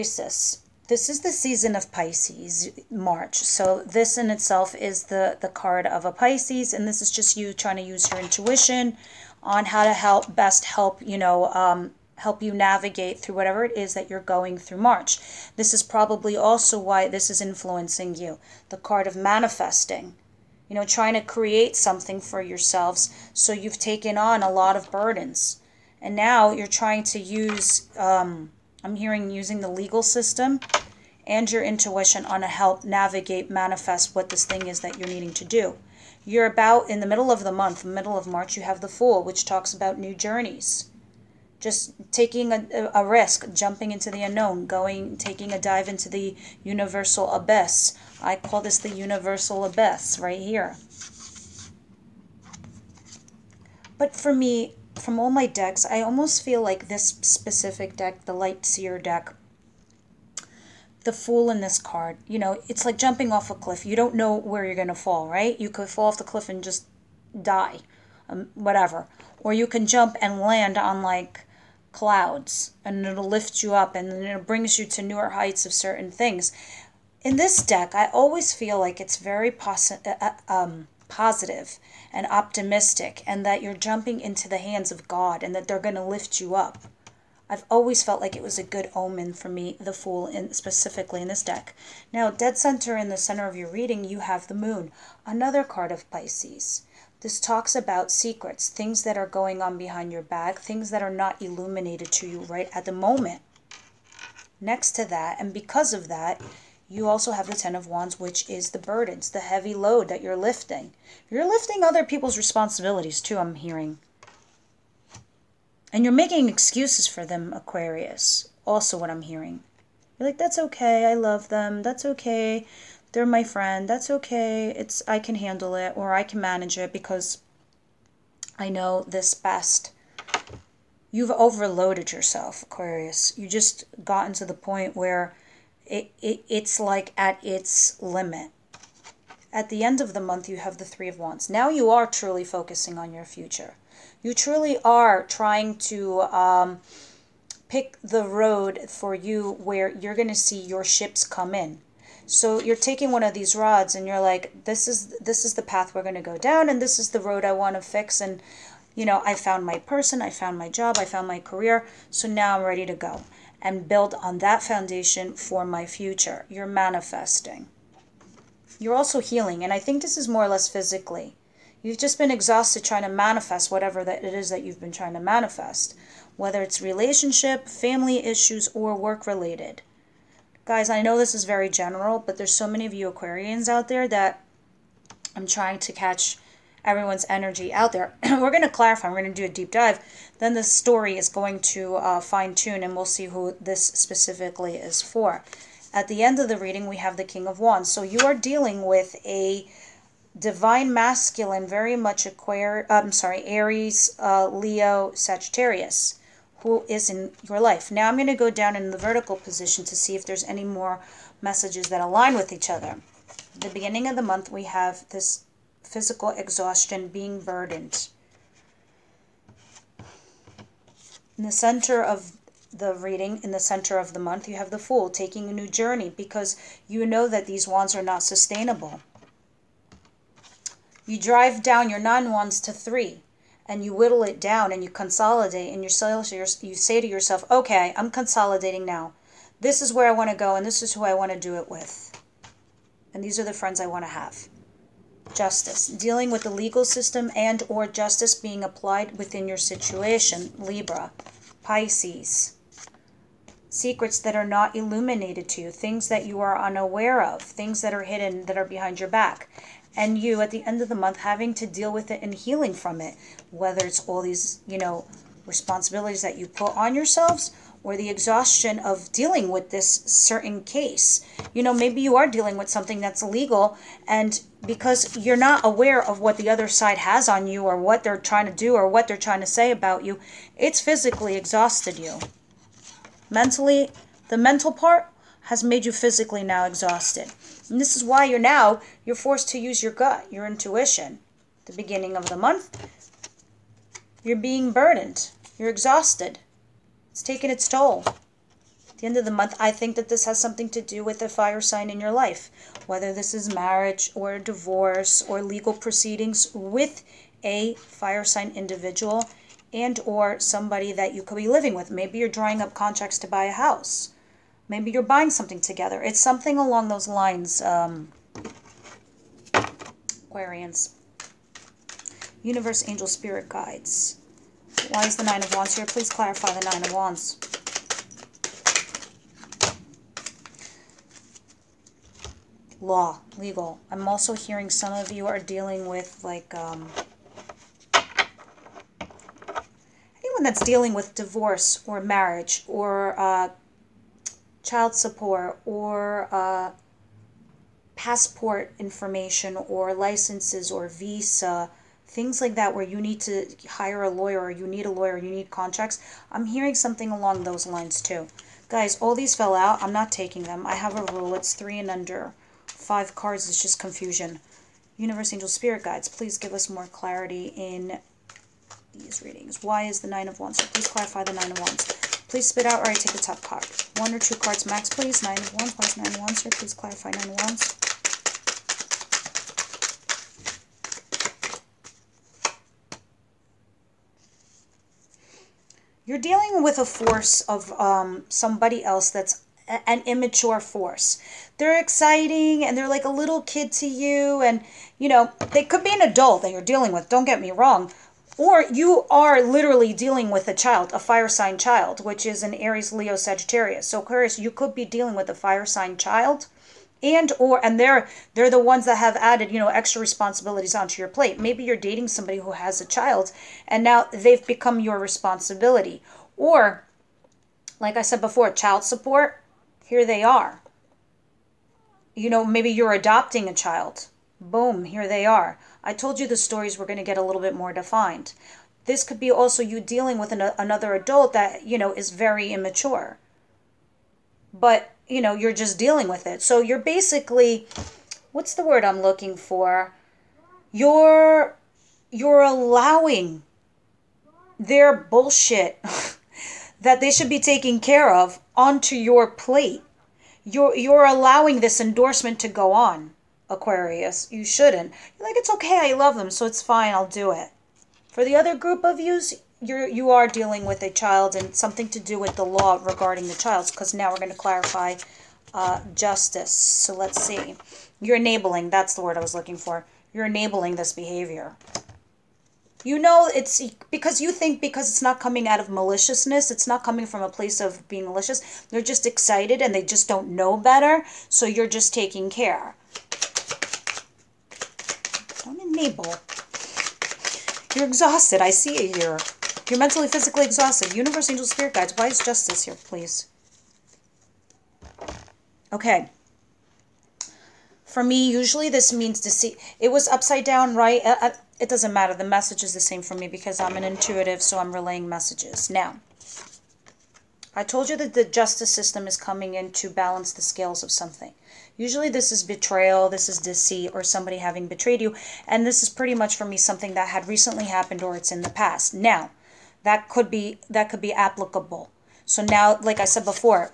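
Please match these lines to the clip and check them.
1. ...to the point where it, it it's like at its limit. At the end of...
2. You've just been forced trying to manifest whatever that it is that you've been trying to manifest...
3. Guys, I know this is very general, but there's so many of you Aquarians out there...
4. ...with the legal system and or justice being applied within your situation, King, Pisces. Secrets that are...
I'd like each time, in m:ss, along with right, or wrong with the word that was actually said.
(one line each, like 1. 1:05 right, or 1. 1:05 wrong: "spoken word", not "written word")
1. 2:14 right
2. 2:51 wrong: "exhausted", not "forced"
3. 3:00 right
4. 4:06 wrong: "Libra", not "King".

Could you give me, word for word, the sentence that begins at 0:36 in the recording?
You're about in the middle of the month, middle of March, you have the Fool, which talks about new journeys.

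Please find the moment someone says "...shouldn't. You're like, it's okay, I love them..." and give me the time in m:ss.
7:34.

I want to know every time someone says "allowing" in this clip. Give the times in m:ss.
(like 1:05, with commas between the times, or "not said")
7:22, 7:31.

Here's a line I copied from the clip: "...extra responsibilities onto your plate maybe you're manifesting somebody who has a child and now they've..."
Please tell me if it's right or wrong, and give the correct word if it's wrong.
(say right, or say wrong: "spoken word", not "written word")
wrong: "dating", not "manifesting".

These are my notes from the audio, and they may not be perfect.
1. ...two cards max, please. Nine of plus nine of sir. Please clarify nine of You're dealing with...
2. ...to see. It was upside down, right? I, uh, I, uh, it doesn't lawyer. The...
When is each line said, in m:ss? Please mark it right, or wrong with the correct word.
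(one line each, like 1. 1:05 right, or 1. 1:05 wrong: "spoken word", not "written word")
1. 6:14 right
2. 8:19 wrong: "matter", not "lawyer".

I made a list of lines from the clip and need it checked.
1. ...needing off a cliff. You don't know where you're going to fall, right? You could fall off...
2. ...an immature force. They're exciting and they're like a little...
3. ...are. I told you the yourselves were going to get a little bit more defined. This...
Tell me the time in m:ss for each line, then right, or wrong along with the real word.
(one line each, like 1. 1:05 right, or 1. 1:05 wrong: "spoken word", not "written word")
1. 1:02 wrong: "jumping", not "needing"
2. 6:29 right
3. 7:05 wrong: "stories", not "yourselves".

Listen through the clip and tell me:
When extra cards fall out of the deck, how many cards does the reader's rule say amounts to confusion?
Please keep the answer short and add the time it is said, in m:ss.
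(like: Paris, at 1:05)
5, at 6:02.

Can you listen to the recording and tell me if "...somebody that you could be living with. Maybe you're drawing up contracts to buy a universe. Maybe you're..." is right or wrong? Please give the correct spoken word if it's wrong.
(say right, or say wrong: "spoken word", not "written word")
wrong: "house", not "universe".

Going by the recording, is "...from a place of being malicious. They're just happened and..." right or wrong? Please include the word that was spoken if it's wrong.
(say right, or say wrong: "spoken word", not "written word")
wrong: "excited", not "happened".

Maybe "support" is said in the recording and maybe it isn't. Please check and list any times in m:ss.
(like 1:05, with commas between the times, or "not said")
5:44, 6:58.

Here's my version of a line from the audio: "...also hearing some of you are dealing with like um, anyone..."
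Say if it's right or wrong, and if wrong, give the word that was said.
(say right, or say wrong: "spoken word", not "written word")
right.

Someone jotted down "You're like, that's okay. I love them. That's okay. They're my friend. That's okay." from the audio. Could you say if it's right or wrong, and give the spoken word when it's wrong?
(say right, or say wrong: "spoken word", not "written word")
right.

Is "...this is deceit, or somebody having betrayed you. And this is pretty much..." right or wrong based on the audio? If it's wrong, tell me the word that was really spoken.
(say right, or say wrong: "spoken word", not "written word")
right.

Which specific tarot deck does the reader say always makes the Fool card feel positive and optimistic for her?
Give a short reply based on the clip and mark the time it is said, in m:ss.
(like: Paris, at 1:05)
Light Seer deck, at 0:58.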